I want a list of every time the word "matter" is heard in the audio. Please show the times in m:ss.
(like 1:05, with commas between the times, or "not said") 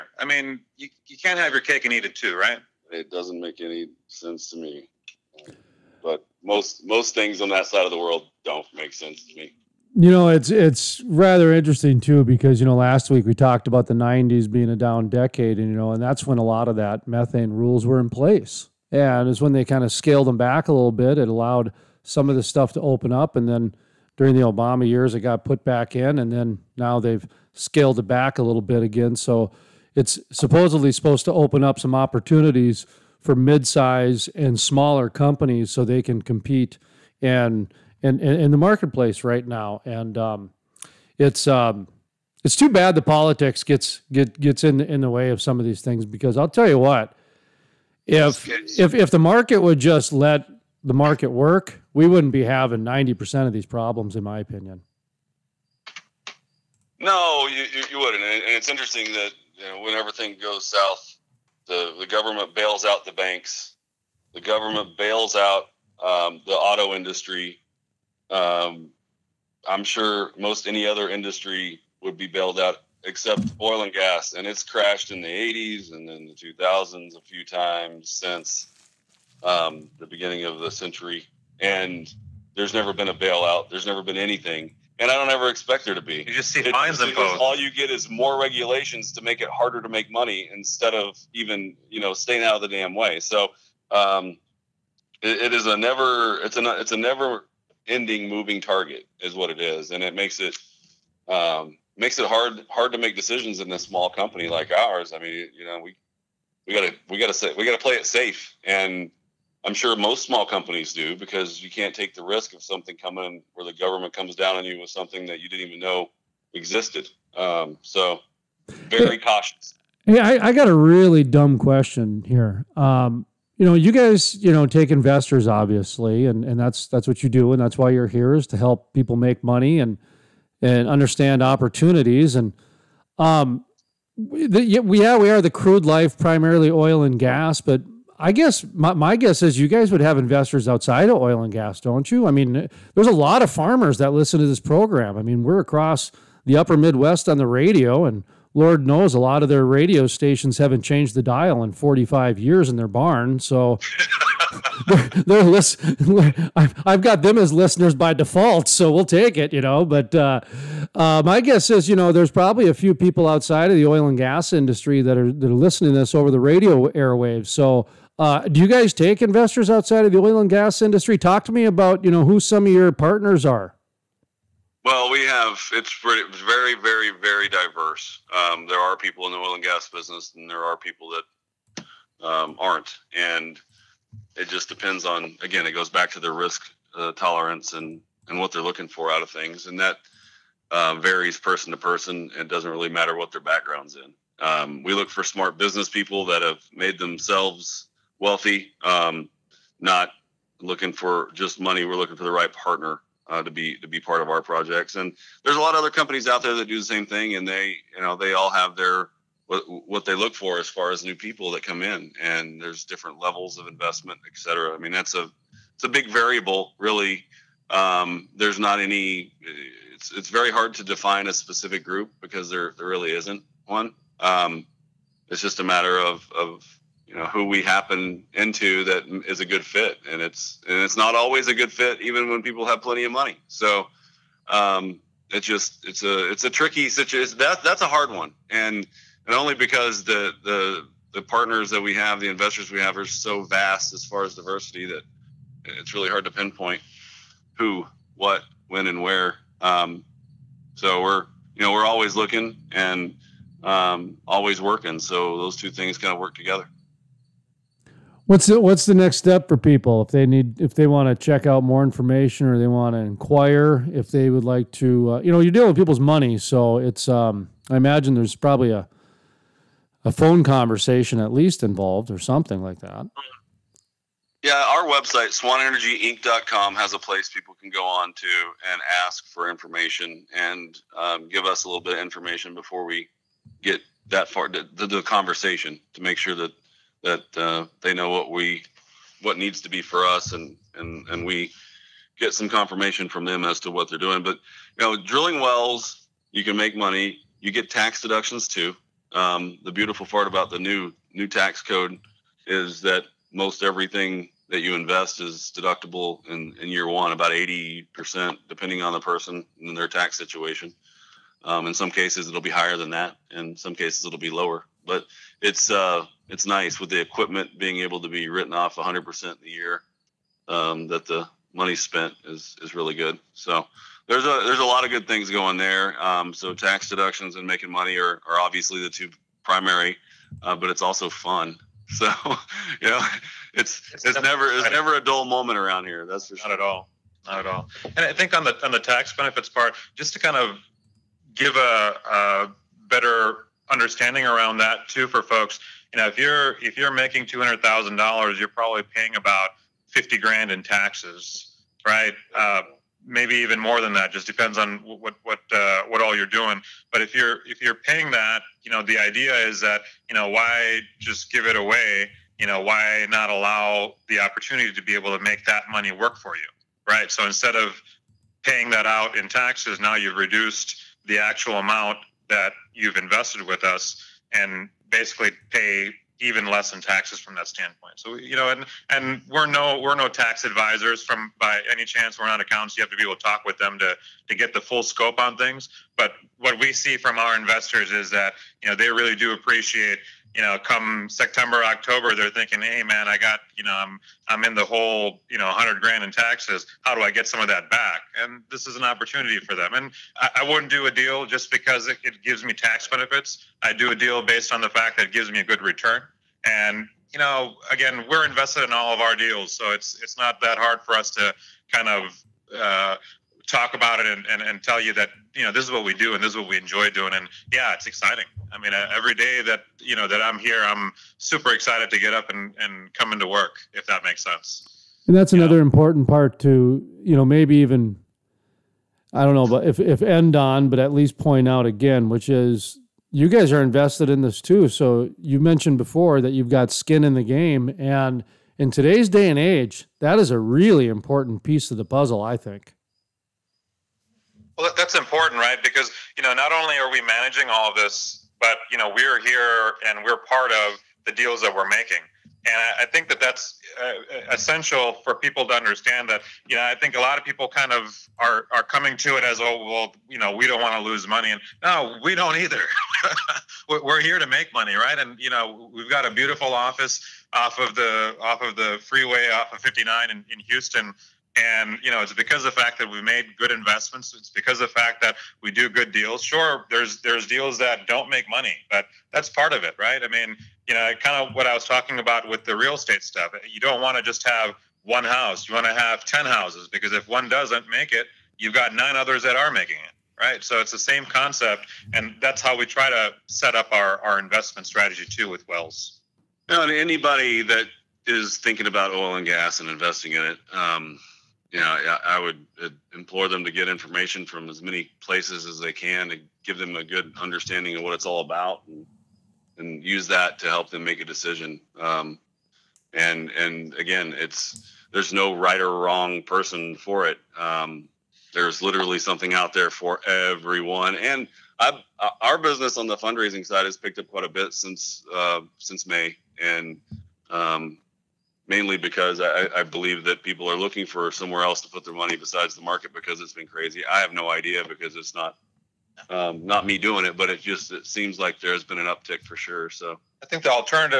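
3:12, 3:45.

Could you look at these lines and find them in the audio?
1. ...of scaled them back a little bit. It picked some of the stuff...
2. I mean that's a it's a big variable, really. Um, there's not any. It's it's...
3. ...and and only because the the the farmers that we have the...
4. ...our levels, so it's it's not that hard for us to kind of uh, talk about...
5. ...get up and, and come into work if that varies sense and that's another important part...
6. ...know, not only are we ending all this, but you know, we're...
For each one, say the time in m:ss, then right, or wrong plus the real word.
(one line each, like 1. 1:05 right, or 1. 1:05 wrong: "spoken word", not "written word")
1. 0:19 wrong: "allowed", not "picked"
2. 3:34 right
3. 3:58 wrong: "partners", not "farmers"
4. 6:48 wrong: "deals", not "levels"
5. 7:01 wrong: "makes", not "varies"
6. 7:26 wrong: "managing", not "ending".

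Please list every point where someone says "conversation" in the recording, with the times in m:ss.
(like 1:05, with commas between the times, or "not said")
4:30, 4:45.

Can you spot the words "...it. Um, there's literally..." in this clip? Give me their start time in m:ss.
8:37.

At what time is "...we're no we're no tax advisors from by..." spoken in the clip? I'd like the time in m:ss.
6:19.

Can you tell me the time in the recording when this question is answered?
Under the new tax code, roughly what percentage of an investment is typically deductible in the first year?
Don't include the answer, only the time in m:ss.
5:07.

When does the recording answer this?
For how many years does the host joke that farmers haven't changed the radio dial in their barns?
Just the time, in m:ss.
2:31.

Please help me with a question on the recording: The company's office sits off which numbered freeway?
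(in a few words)
59.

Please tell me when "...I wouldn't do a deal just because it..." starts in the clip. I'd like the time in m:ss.
6:40.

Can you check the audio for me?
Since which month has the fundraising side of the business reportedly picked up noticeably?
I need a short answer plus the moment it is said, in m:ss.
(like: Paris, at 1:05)
May, at 8:45.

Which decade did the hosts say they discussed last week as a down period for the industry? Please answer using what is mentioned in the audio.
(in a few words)
the '90s.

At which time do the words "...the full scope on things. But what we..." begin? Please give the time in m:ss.
6:24.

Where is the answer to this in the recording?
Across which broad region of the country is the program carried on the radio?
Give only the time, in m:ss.
2:26.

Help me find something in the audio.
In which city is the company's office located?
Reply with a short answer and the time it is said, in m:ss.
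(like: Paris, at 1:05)
Houston, at 7:50.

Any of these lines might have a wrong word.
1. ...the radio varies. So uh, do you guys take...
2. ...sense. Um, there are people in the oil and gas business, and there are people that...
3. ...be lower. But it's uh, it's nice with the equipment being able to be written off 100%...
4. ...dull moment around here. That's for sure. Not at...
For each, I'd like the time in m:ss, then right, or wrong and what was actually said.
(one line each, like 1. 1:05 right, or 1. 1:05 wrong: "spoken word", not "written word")
1. 2:46 wrong: "airwaves", not "varies"
2. 2:57 wrong: "diverse", not "sense"
3. 5:14 right
4. 5:35 right.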